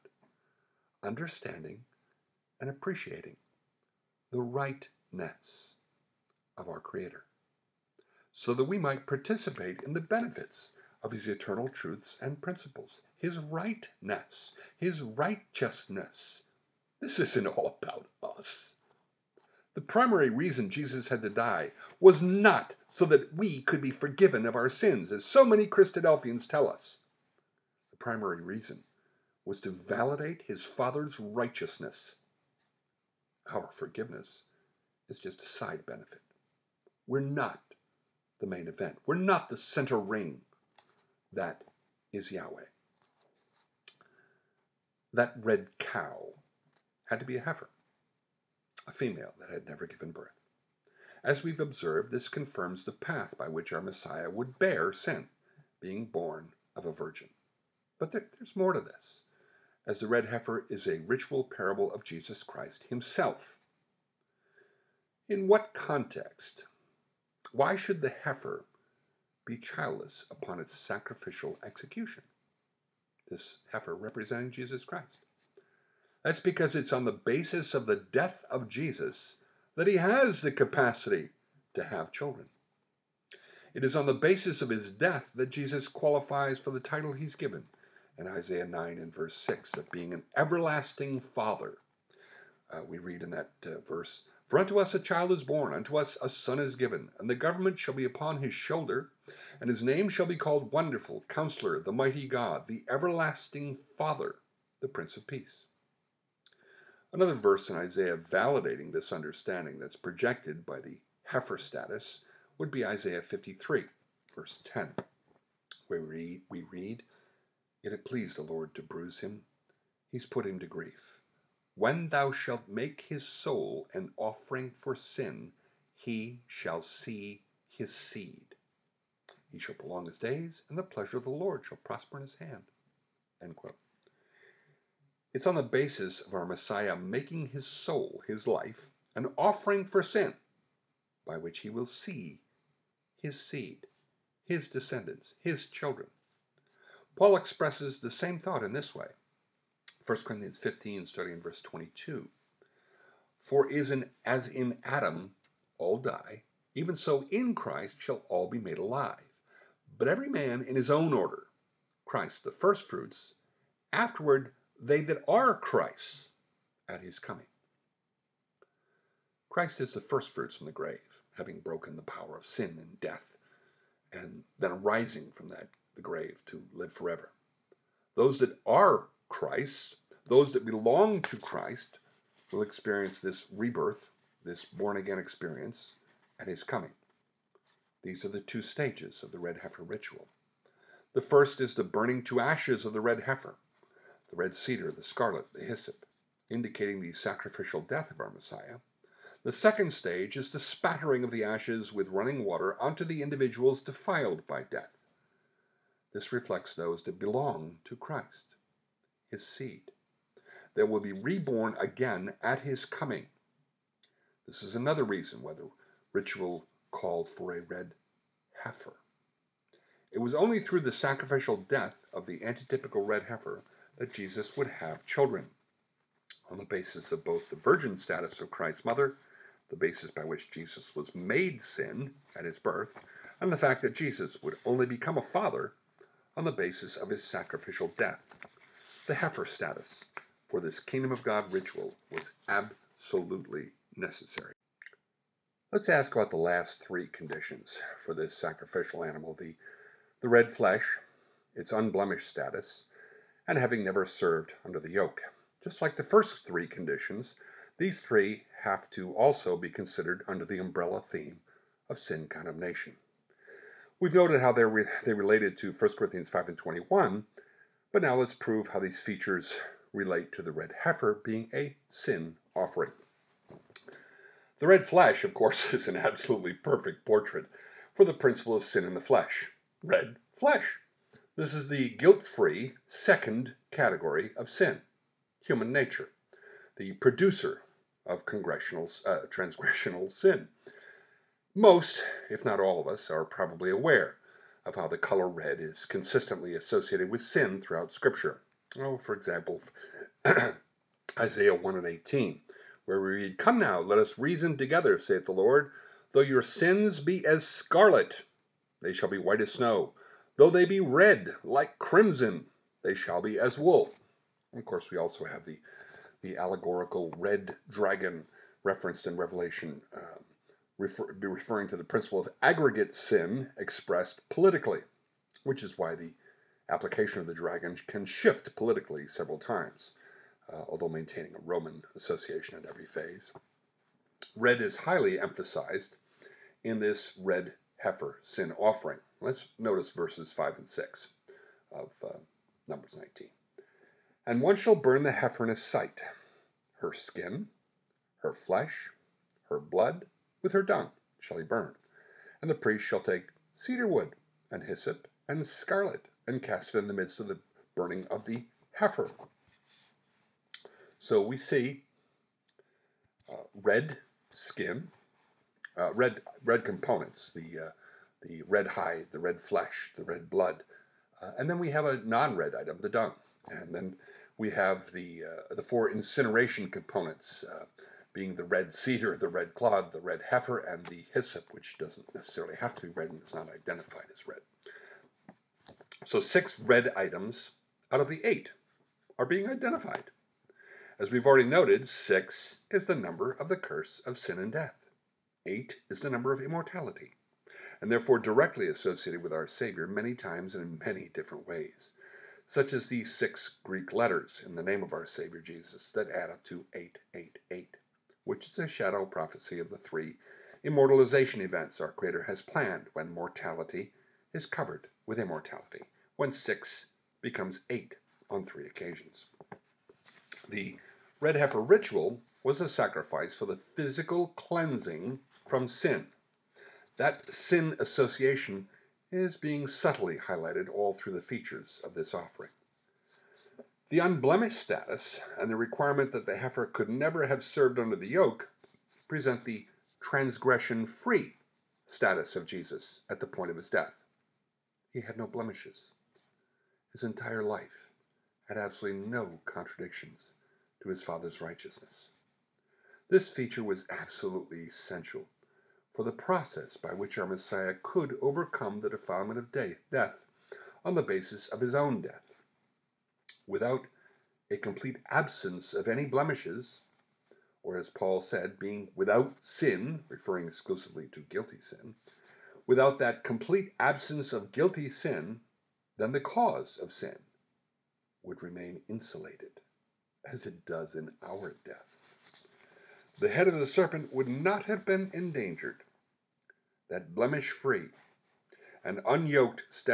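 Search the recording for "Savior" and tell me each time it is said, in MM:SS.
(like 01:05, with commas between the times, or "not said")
06:39, 06:45.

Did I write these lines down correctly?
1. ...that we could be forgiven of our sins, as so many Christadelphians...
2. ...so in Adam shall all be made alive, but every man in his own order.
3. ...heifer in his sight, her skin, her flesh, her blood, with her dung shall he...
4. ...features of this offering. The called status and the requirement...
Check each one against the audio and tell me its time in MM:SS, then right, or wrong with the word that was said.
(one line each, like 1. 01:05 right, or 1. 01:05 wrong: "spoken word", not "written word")
1. 00:23 right
2. 02:36 wrong: "Christ", not "Adam"
3. 05:45 right
4. 07:11 wrong: "unblemished", not "called".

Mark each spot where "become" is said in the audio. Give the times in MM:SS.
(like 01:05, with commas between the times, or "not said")
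03:54, 06:57.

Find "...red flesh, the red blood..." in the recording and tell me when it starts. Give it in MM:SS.
06:09.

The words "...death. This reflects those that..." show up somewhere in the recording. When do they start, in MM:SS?
03:24.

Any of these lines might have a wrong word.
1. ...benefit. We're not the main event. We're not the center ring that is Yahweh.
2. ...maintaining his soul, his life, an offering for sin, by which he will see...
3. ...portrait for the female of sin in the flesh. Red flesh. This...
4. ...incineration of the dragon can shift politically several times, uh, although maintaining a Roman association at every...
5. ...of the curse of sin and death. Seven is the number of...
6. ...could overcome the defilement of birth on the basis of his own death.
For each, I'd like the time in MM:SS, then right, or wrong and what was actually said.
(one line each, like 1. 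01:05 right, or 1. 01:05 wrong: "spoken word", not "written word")
1. 00:35 right
2. 02:16 wrong: "making", not "maintaining"
3. 04:37 wrong: "principle", not "female"
4. 05:26 wrong: "application", not "incineration"
5. 06:33 wrong: "Eight", not "Seven"
6. 07:37 wrong: "death", not "birth".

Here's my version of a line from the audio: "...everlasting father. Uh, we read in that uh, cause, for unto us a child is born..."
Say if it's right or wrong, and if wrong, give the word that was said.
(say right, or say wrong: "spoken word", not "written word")
wrong: "verse", not "cause".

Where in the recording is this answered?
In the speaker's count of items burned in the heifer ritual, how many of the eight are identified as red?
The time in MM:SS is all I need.
06:26.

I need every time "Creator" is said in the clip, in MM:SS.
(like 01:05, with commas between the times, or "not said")
00:06, 06:51.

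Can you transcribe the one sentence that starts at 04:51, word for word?
Most, if not all of us, are probably aware of how the color red is consistently associated with sin throughout Scripture.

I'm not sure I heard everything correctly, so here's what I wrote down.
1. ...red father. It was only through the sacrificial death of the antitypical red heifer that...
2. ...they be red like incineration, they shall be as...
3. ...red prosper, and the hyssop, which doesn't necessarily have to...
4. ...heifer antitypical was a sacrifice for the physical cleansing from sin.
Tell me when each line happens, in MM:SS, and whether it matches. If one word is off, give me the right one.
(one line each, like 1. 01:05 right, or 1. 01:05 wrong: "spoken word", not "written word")
1. 03:37 wrong: "heifer", not "father"
2. 05:10 wrong: "crimson", not "incineration"
3. 06:20 wrong: "heifer", not "prosper"
4. 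07:01 wrong: "ritual", not "antitypical".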